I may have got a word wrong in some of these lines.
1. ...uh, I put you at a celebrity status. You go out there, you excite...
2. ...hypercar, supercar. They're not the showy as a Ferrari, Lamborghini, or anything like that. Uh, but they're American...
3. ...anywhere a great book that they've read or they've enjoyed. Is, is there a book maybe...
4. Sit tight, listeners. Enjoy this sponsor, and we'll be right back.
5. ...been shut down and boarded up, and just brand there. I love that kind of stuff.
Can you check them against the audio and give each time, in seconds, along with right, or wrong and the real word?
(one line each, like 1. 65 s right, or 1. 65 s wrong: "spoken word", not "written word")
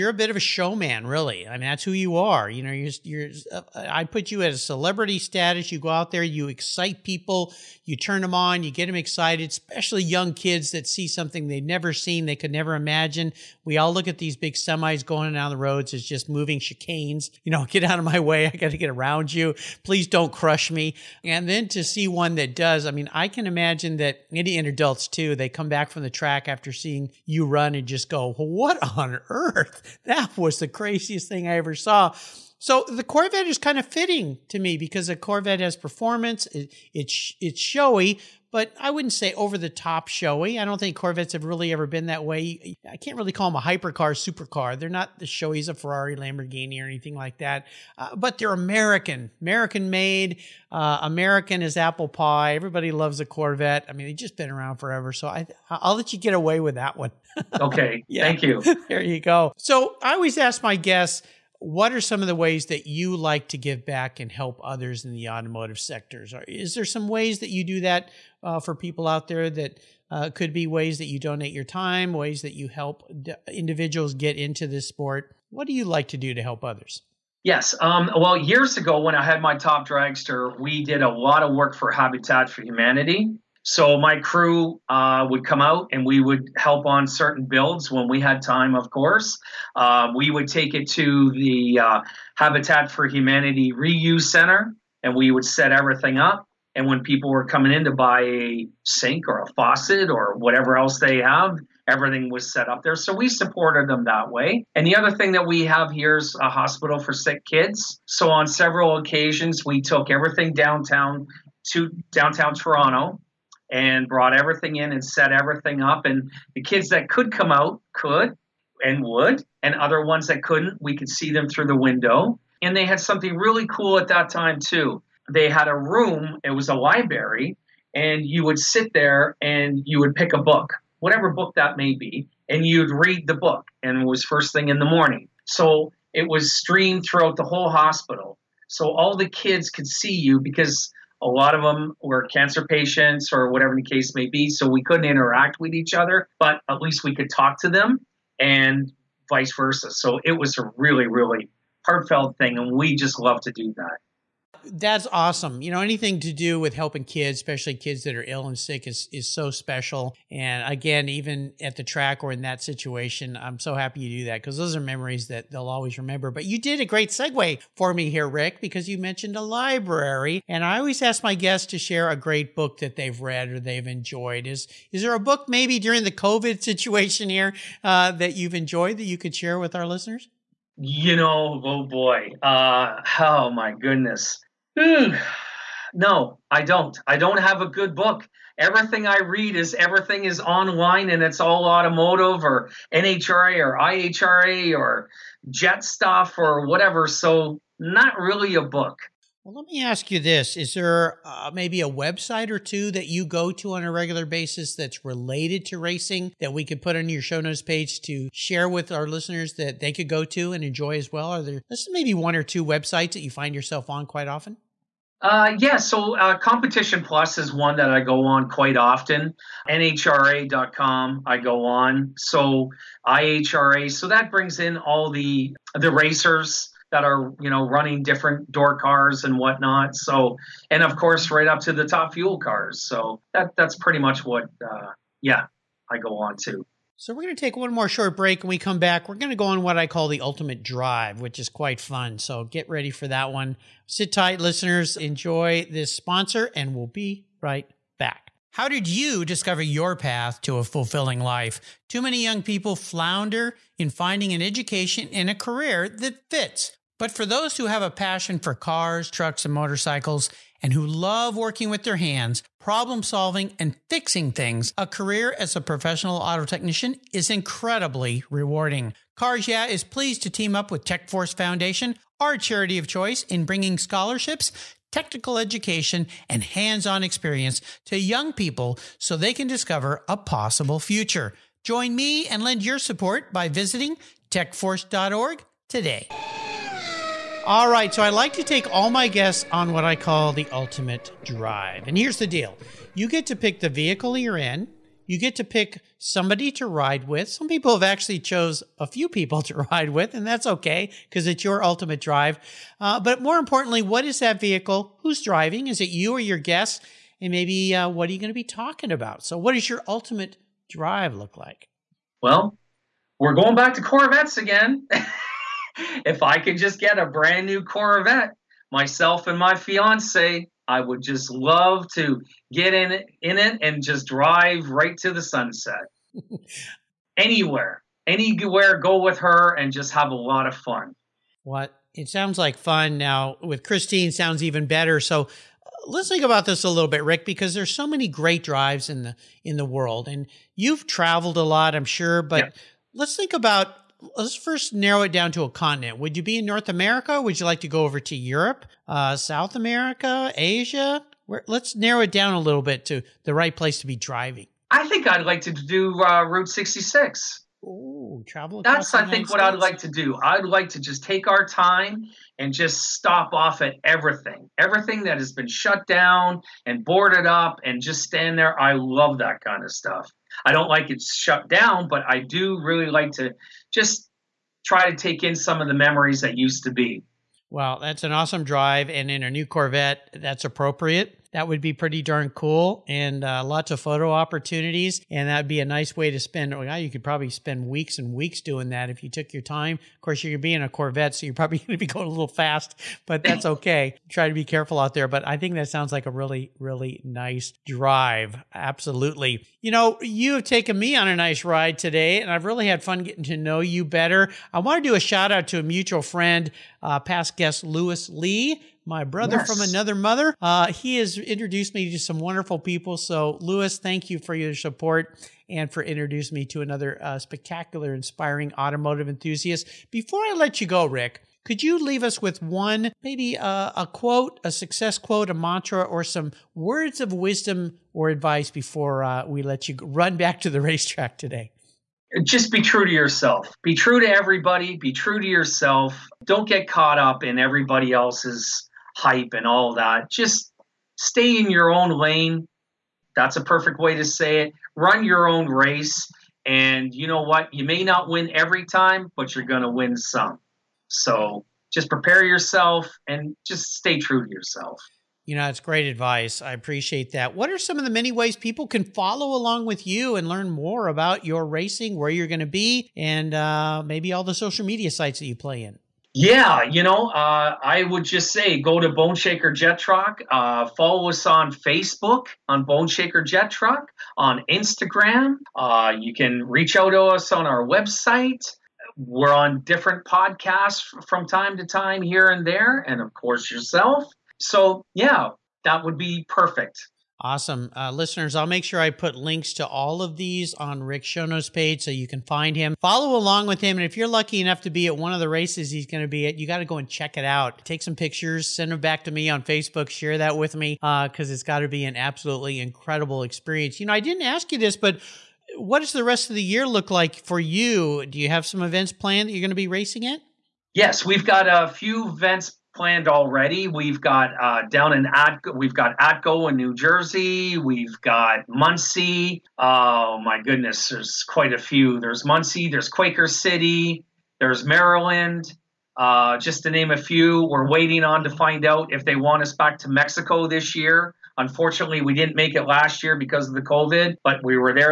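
1. 3 s right
2. 43 s right
3. 171 s wrong: "share", not "anywhere"
4. 243 s right
5. 365 s wrong: "stand", not "brand".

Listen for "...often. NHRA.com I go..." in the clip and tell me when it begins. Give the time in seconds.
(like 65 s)
218 s.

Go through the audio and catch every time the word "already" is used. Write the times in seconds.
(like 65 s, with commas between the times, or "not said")
513 s.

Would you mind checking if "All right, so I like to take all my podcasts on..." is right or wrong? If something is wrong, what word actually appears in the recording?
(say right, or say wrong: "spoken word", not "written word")
wrong: "guests", not "podcasts".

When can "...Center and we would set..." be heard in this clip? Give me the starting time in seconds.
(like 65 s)
94 s.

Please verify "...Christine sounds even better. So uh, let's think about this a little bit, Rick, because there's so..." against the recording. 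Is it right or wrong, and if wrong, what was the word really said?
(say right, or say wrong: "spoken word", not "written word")
right.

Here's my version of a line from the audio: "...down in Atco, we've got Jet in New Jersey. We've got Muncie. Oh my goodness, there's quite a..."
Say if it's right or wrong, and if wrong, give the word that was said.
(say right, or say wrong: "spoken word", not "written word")
wrong: "Atco", not "Jet".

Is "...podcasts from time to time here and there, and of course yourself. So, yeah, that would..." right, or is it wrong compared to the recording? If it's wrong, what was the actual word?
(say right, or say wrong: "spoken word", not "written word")
right.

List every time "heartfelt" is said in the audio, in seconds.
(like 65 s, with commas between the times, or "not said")
151 s.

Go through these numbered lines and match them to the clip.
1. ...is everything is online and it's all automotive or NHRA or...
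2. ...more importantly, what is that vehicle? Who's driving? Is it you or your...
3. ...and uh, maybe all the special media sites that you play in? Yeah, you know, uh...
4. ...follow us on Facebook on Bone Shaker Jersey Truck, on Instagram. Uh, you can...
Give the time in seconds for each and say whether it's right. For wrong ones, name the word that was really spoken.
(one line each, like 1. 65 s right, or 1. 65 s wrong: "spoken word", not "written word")
1. 189 s right
2. 303 s right
3. 462 s wrong: "social", not "special"
4. 470 s wrong: "Jet", not "Jersey".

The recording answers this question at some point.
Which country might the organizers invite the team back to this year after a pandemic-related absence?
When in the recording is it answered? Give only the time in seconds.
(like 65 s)
529 s.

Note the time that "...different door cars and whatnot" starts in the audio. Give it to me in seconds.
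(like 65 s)
228 s.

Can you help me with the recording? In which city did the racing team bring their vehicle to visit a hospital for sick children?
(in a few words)
Toronto.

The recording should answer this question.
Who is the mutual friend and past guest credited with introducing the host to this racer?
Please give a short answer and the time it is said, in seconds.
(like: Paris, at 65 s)
Lewis Lee, at 407 s.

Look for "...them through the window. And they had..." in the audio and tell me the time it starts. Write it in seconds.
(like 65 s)
121 s.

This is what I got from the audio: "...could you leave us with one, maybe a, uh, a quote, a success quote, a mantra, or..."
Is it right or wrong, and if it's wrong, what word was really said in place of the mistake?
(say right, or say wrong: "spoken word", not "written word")
right.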